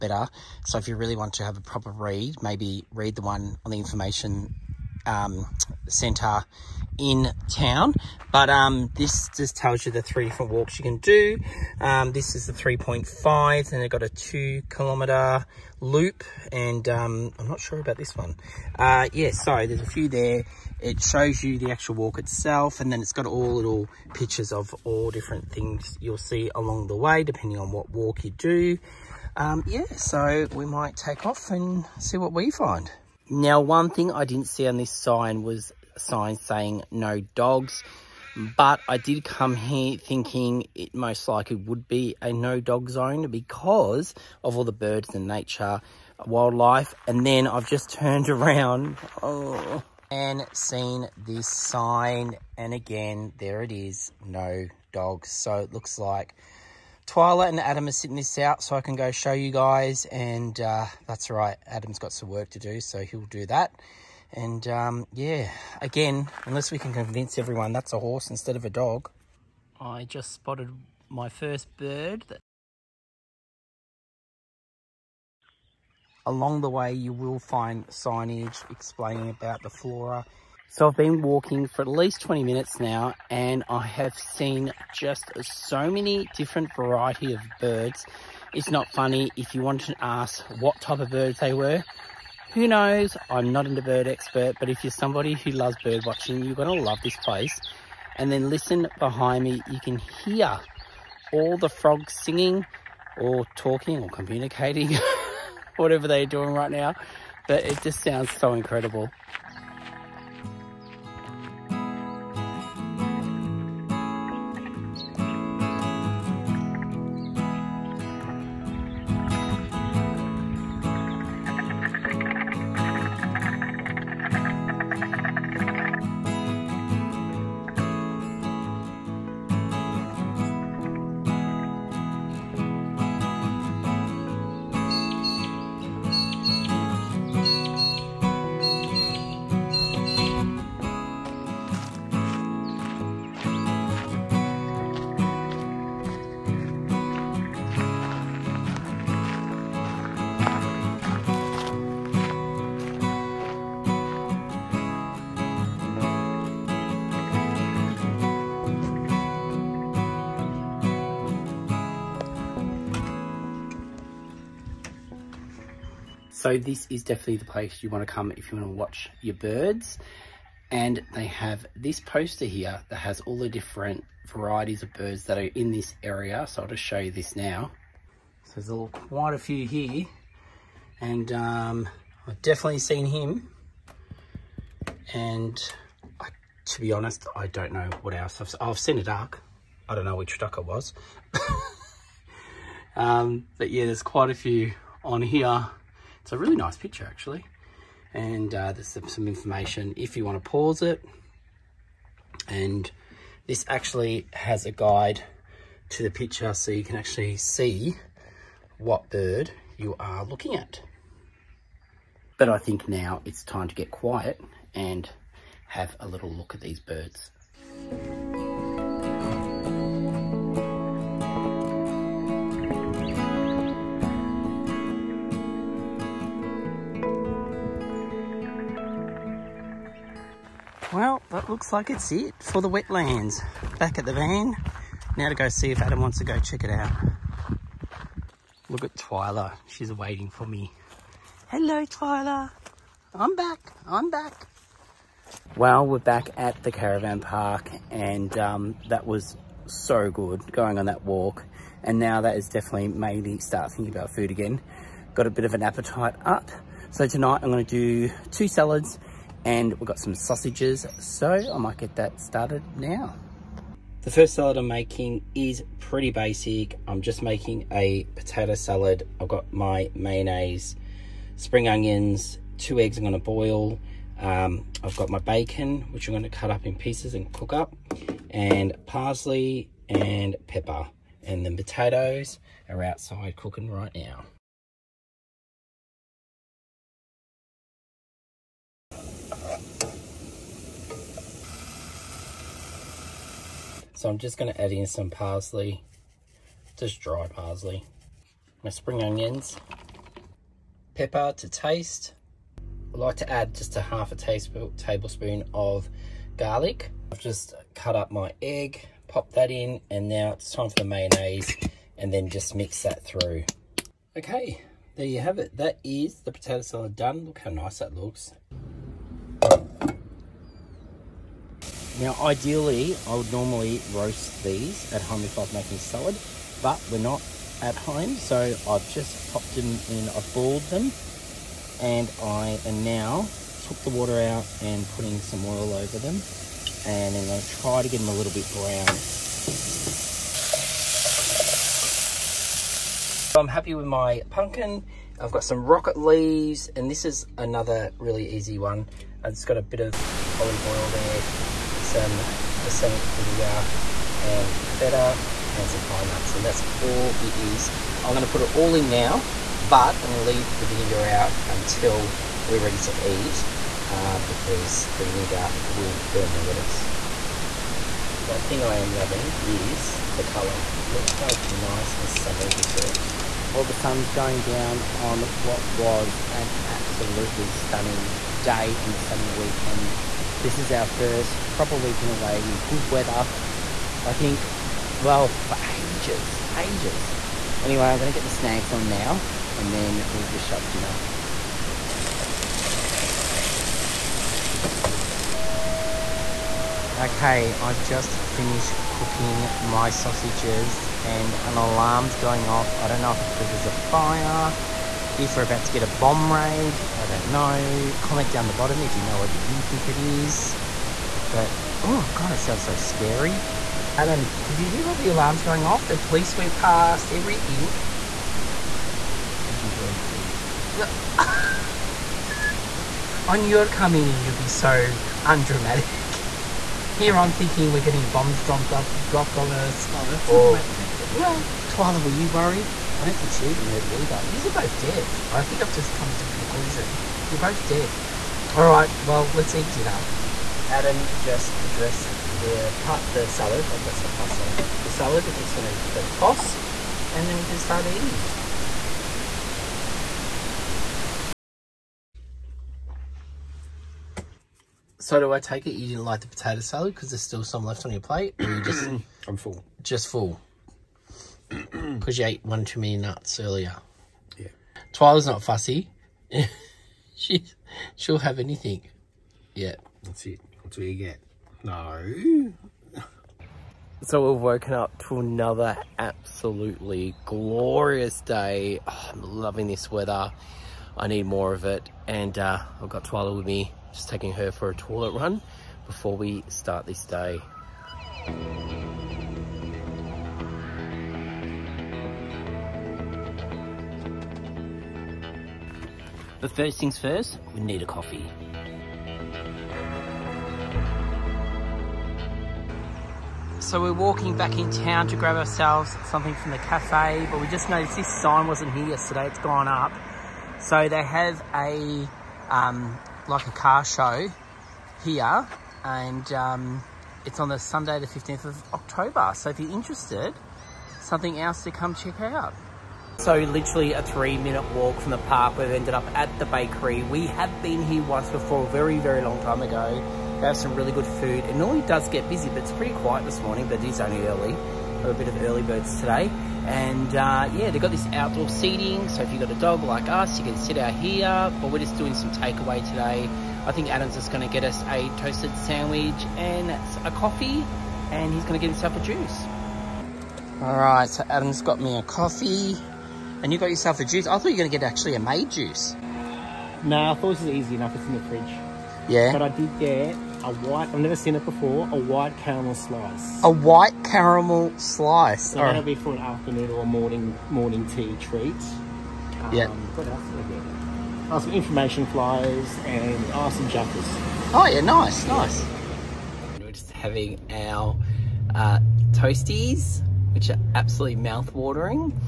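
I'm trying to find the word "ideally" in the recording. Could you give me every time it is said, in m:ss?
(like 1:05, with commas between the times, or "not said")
5:22.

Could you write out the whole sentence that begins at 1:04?
And um, yeah, again, unless we can convince everyone that's a horse instead of a dog.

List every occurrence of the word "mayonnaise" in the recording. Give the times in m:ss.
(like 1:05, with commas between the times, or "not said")
4:29, 5:10.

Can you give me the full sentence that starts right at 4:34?
Um, I've got my bacon, which I'm gonna cut up in pieces and cook up, and parsley and pepper.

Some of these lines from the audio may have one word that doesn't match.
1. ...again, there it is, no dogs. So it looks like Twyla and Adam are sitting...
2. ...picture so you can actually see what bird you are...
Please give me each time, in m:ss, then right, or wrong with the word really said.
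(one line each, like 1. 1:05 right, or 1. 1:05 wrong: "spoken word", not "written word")
1. 0:52 right
2. 3:26 right.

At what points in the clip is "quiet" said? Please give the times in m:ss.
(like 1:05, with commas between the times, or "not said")
3:33, 8:52.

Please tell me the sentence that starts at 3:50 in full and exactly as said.
Well, that looks like it's it for the wetlands.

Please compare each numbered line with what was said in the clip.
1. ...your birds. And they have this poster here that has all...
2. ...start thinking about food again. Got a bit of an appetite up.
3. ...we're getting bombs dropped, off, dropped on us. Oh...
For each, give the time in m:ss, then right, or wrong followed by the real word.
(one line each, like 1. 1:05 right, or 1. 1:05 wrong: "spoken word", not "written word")
1. 2:49 right
2. 4:13 right
3. 7:07 right.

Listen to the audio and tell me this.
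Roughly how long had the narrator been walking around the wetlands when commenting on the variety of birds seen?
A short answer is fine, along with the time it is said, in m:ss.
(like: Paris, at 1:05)
20 minutes, at 1:22.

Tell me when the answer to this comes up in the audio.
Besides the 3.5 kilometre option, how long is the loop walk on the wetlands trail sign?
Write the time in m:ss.
0:14.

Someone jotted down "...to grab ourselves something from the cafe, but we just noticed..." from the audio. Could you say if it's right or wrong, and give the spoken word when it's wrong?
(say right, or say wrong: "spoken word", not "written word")
right.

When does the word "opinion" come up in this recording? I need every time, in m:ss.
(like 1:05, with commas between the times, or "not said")
not said.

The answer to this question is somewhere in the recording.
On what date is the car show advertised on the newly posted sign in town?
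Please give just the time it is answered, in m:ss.
8:37.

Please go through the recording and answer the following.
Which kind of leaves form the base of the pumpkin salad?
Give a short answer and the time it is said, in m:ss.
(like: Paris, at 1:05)
Rocket, at 5:45.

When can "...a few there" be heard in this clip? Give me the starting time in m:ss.
0:19.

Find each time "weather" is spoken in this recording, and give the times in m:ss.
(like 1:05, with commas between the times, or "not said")
6:22, 7:59.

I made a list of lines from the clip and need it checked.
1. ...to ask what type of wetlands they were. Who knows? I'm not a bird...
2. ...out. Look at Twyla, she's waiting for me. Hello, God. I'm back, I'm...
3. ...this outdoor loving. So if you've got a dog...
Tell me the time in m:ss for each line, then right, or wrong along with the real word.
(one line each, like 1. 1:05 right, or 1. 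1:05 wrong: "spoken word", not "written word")
1. 1:29 wrong: "birds", not "wetlands"
2. 3:56 wrong: "Twyla", not "God"
3. 8:57 wrong: "seating", not "loving".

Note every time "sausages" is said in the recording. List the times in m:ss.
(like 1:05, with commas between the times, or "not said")
4:20, 6:39.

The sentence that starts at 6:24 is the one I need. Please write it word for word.
I think, well, for ages, ages.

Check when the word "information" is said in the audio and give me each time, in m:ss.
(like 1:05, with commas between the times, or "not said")
0:03, 3:19, 9:31.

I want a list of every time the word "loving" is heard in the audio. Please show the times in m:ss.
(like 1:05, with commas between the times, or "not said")
6:08, 7:59.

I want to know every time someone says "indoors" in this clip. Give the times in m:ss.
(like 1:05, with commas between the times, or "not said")
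not said.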